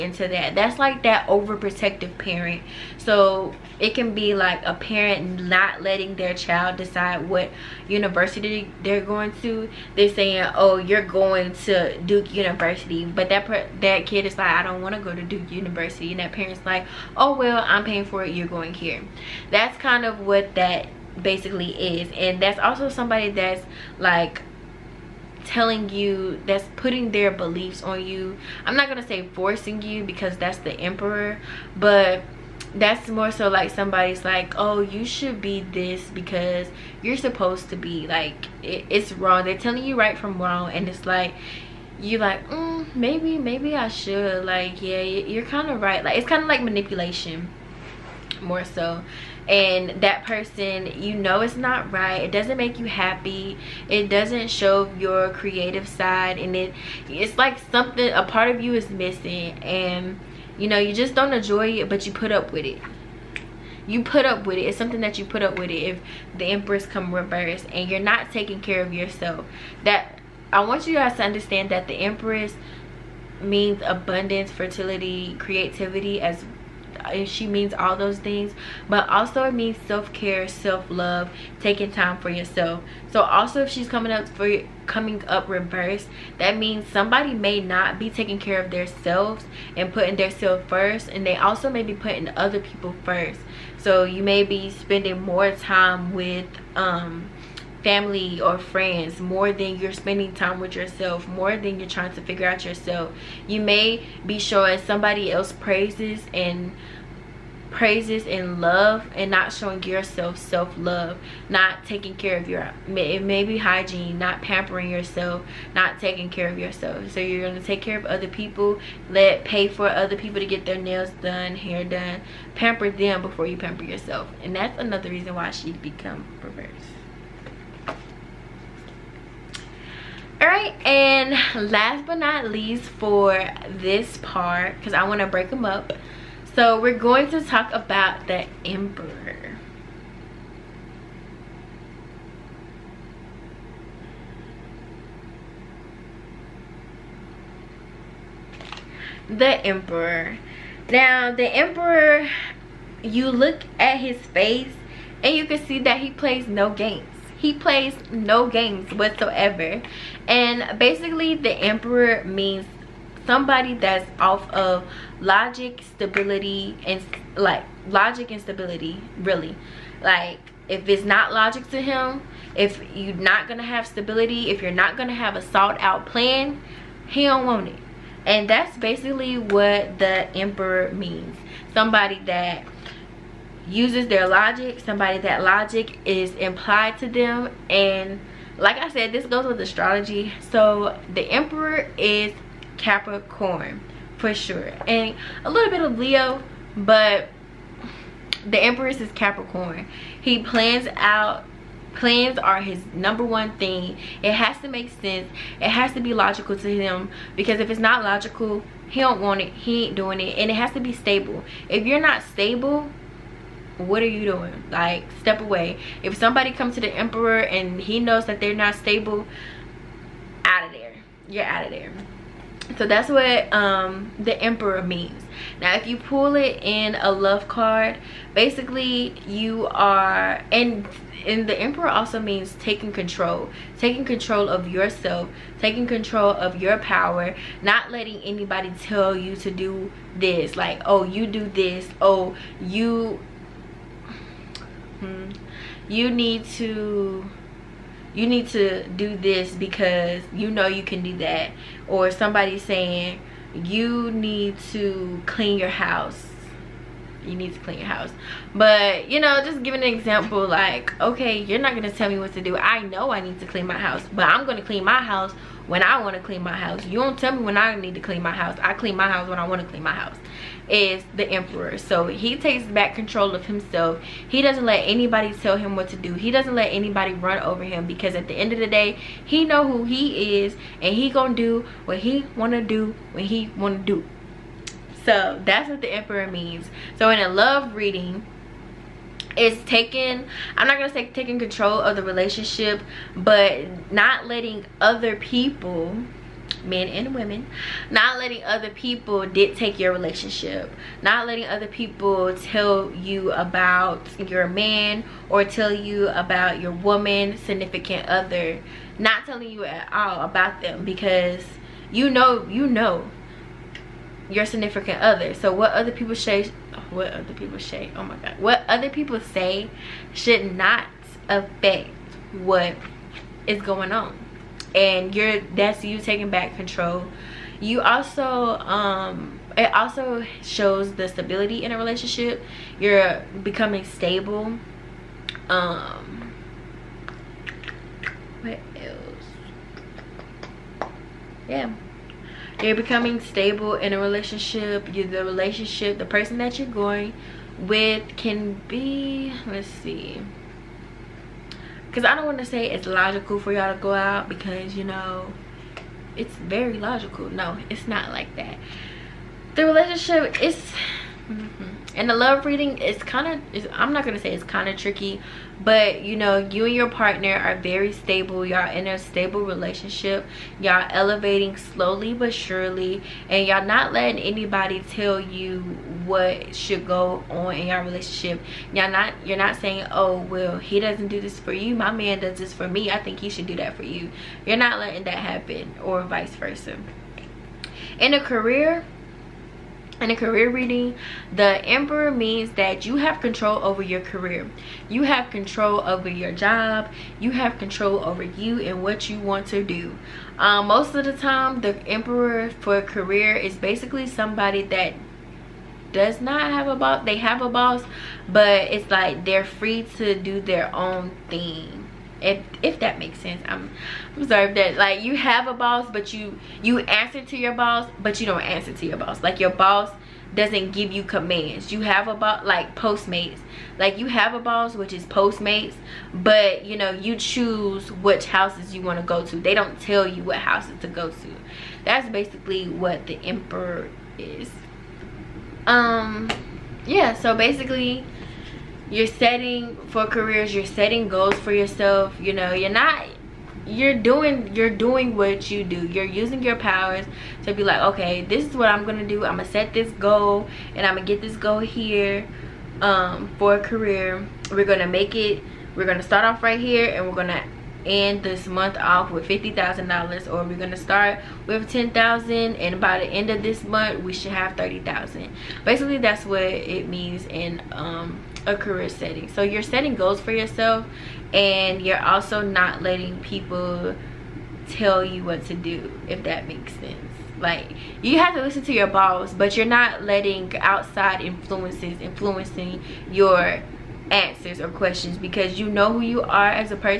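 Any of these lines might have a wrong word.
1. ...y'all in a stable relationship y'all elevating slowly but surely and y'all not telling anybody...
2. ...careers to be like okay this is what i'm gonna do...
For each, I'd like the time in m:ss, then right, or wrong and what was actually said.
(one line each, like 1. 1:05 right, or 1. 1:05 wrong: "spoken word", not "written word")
1. 6:08 wrong: "letting", not "telling"
2. 7:26 wrong: "powers", not "careers".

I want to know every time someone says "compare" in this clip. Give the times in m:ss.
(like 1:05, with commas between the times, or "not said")
not said.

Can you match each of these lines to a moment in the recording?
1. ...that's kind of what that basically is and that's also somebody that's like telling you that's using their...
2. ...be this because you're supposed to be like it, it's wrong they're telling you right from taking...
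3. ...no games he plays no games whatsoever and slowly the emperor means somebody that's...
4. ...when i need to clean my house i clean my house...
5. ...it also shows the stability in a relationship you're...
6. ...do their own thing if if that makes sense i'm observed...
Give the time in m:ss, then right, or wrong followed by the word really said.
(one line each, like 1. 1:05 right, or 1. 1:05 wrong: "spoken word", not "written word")
1. 0:19 wrong: "putting", not "using"
2. 0:35 wrong: "wrong", not "taking"
3. 2:36 wrong: "basically", not "slowly"
4. 4:27 right
5. 5:29 right
6. 6:50 right.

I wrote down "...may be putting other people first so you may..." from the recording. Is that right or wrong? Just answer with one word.
right.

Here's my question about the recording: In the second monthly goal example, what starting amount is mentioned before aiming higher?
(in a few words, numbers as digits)
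$10,000.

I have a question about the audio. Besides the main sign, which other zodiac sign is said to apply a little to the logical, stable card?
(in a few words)
Leo.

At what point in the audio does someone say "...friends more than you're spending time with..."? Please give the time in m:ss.
1:38.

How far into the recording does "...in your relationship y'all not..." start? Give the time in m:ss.
6:17.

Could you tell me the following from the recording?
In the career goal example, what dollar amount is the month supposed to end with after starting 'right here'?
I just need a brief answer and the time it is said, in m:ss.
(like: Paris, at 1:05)
$50,000, at 7:39.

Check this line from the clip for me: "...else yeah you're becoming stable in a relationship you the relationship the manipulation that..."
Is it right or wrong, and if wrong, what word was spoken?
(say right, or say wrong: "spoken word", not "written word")
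wrong: "person", not "manipulation".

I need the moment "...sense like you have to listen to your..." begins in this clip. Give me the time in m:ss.
7:56.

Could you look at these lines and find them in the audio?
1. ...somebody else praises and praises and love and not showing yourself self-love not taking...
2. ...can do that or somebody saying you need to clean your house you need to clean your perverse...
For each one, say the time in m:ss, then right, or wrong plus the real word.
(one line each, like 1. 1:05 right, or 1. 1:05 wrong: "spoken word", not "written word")
1. 1:44 right
2. 4:10 wrong: "house", not "perverse".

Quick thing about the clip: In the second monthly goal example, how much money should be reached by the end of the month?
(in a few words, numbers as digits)
$30,000.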